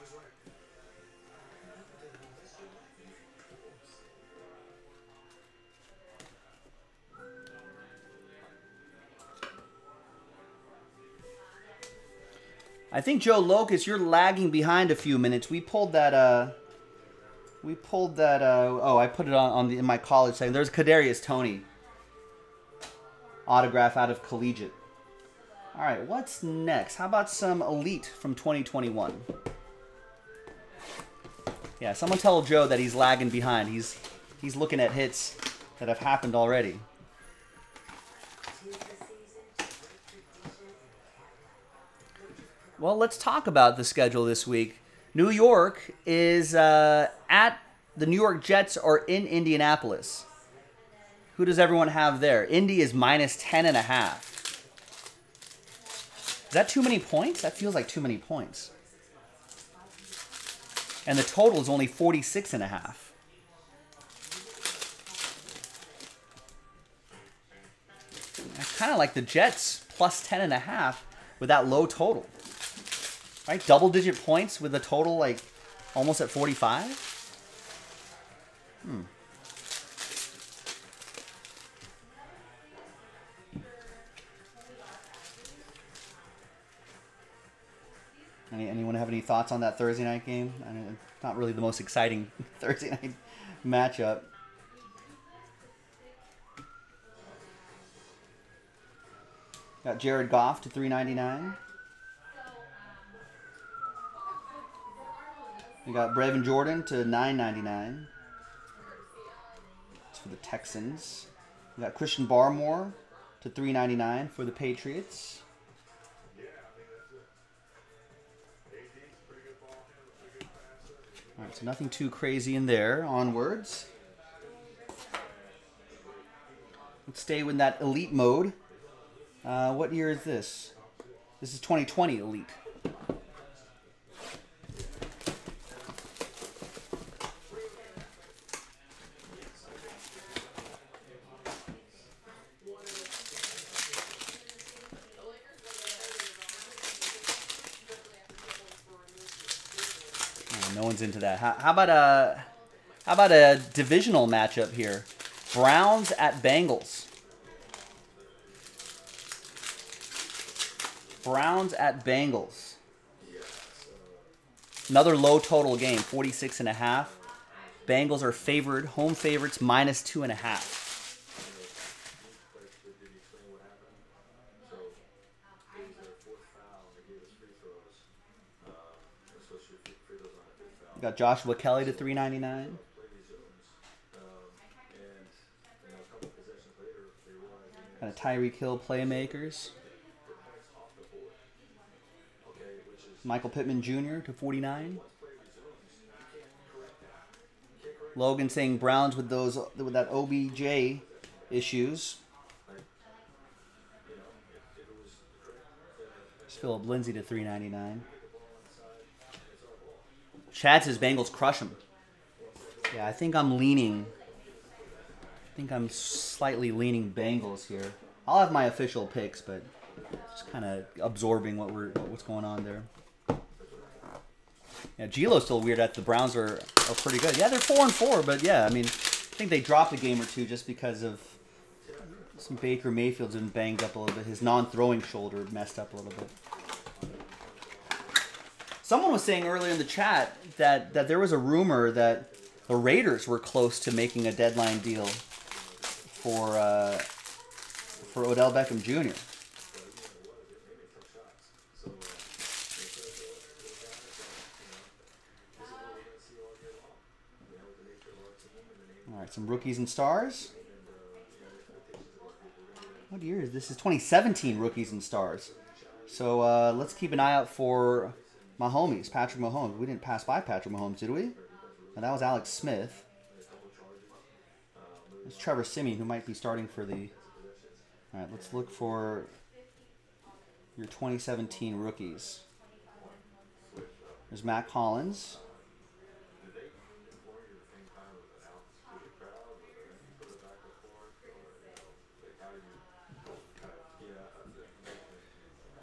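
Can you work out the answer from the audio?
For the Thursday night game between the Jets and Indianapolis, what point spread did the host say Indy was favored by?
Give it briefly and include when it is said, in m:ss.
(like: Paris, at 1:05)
10.5, at 0:52.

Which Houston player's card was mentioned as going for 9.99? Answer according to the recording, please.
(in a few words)
Brevin Jordan.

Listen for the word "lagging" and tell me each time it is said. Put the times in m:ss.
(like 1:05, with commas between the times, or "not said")
0:13, 0:32.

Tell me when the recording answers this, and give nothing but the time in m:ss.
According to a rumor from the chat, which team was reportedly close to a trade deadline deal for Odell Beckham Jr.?
4:02.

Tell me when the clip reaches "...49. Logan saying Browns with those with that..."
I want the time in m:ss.
3:14.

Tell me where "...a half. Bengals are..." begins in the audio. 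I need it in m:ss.
2:46.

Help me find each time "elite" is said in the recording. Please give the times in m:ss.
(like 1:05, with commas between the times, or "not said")
0:27, 2:07, 2:12.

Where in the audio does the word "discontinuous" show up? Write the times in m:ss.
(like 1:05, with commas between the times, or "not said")
not said.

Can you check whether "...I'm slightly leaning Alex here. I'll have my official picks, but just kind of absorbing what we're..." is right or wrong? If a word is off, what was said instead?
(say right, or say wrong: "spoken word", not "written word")
wrong: "Bengals", not "Alex".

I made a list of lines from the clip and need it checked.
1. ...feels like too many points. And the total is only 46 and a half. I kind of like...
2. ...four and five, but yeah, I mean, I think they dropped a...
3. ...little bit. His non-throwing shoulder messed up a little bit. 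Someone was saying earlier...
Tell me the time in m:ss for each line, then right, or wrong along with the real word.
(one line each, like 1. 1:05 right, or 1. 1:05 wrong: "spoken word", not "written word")
1. 0:57 right
2. 3:47 wrong: "four", not "five"
3. 3:53 right.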